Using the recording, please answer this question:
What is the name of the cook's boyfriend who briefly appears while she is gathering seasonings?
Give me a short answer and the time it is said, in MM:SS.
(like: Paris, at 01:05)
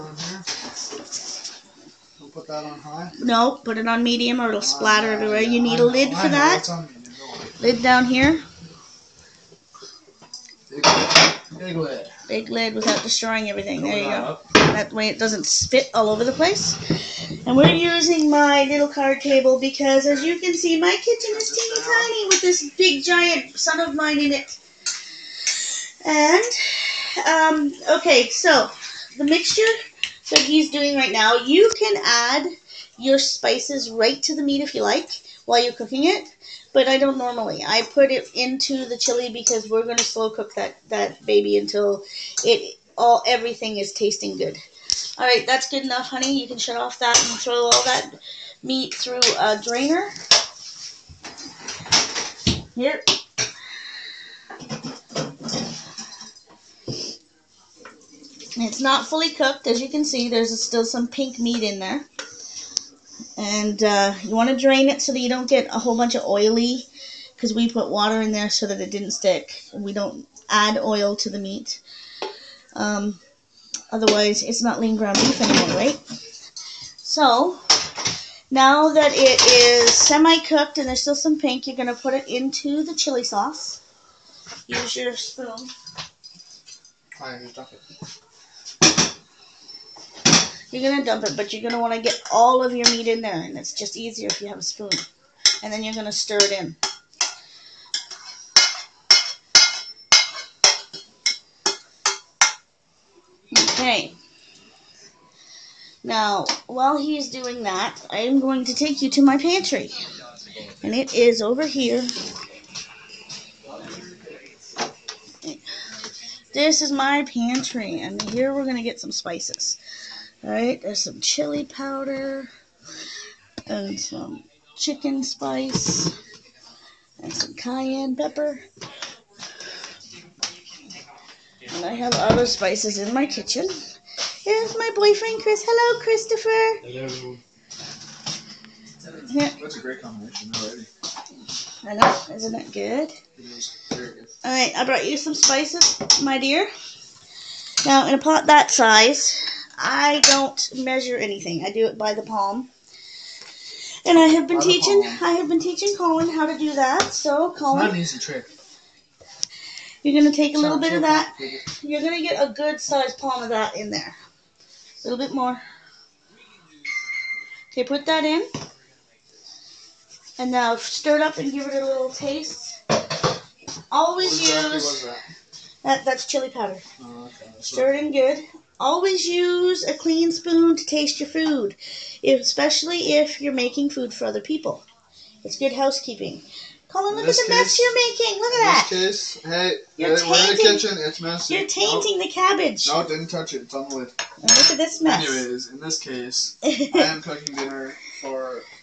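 Chris, at 02:15.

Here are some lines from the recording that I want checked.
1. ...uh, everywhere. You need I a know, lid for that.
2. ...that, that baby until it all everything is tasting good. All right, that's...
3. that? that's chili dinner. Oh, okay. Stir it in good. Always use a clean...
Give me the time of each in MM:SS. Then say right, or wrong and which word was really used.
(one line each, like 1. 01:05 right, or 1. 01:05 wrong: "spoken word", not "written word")
1. 00:05 right
2. 00:40 right
3. 02:55 wrong: "powder", not "dinner".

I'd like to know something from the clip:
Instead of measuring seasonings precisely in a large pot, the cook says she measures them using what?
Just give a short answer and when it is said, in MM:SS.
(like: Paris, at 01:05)
the palm, at 02:32.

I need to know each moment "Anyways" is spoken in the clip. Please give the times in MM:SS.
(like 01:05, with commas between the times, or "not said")
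03:15.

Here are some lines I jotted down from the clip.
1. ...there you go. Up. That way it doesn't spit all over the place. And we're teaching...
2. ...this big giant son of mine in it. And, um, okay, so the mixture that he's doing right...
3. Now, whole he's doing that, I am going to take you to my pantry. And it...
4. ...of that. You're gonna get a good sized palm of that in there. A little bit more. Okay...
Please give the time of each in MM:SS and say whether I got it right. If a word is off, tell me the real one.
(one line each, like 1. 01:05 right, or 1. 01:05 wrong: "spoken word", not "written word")
1. 00:13 wrong: "using", not "teaching"
2. 00:22 right
3. 01:46 wrong: "while", not "whole"
4. 02:40 right.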